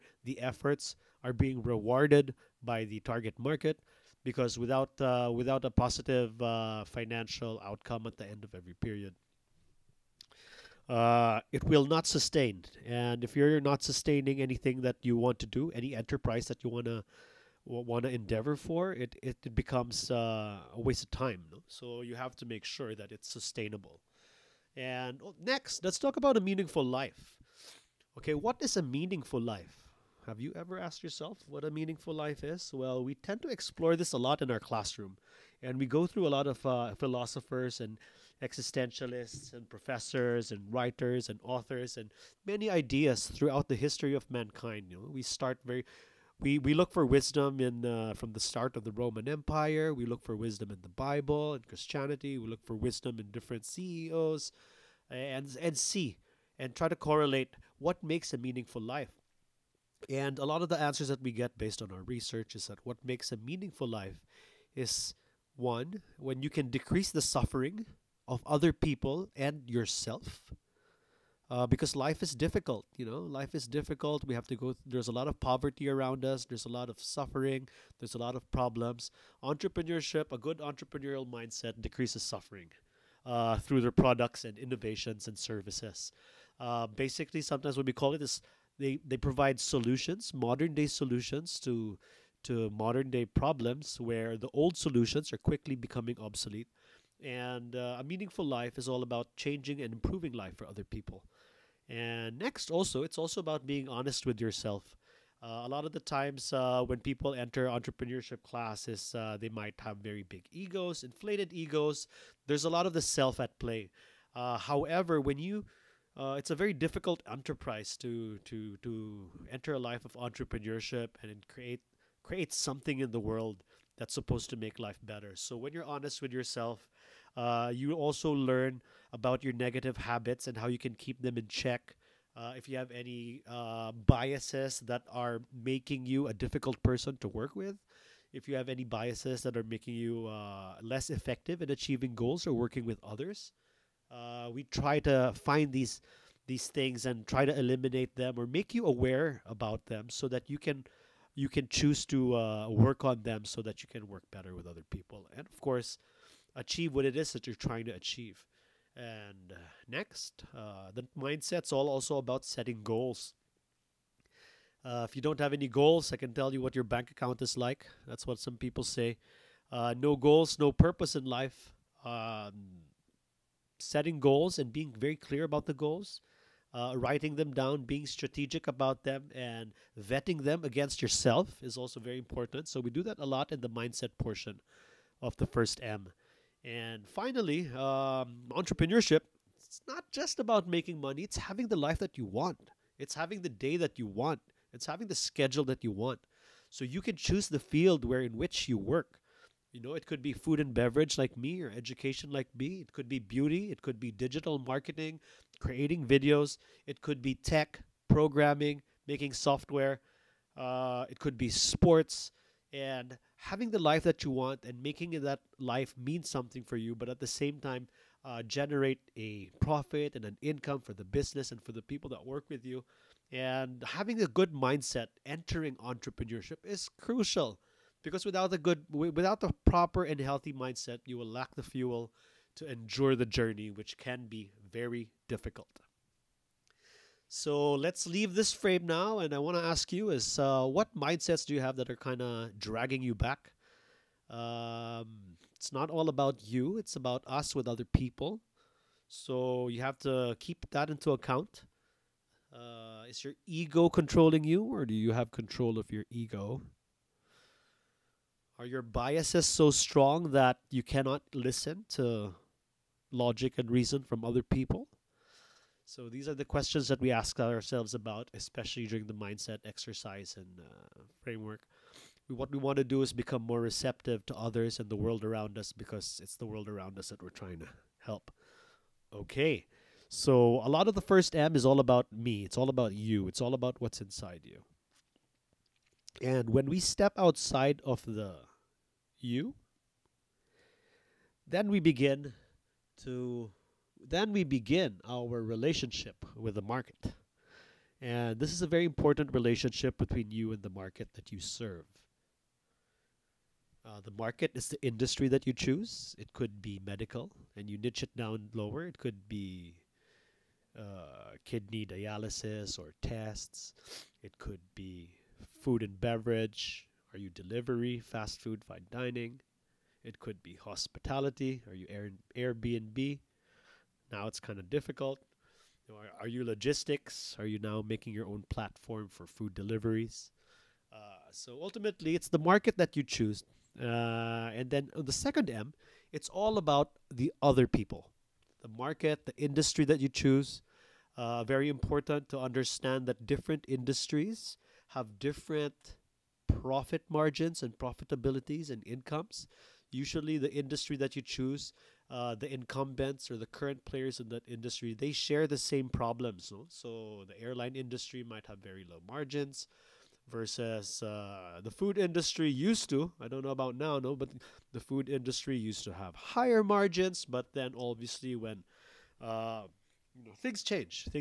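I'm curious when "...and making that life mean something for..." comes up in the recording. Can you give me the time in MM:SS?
03:34.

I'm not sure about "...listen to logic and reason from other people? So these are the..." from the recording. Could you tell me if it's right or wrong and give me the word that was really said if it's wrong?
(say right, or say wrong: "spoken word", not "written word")
right.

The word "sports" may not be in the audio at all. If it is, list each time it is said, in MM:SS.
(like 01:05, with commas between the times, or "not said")
03:31.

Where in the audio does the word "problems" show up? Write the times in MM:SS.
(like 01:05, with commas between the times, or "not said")
01:18, 01:33, 05:55.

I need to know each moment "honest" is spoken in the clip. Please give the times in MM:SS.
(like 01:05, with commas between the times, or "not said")
01:43, 02:05.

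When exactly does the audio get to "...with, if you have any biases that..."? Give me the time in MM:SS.
02:17.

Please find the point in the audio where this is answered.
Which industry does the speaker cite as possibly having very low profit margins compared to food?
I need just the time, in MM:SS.
05:57.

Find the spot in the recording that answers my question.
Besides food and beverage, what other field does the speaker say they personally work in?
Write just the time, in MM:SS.
03:21.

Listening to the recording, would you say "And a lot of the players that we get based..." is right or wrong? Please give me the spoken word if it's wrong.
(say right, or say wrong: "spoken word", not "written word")
wrong: "answers", not "players".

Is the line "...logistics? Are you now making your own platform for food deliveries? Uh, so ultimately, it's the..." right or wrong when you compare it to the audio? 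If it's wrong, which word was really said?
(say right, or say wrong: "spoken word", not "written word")
right.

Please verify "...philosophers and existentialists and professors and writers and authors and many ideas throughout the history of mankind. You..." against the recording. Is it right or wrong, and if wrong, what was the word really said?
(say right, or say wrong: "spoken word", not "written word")
right.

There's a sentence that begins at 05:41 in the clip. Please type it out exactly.
Uh, very important to understand that different industries have different profit margins and profitabilities and incomes.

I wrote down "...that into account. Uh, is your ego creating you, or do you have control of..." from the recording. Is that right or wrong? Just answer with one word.
wrong.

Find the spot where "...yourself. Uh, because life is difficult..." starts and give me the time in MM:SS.
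01:09.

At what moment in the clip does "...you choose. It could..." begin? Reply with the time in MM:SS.
05:05.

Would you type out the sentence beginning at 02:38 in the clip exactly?
And uh, next, uh, the mindset's all also about setting goals.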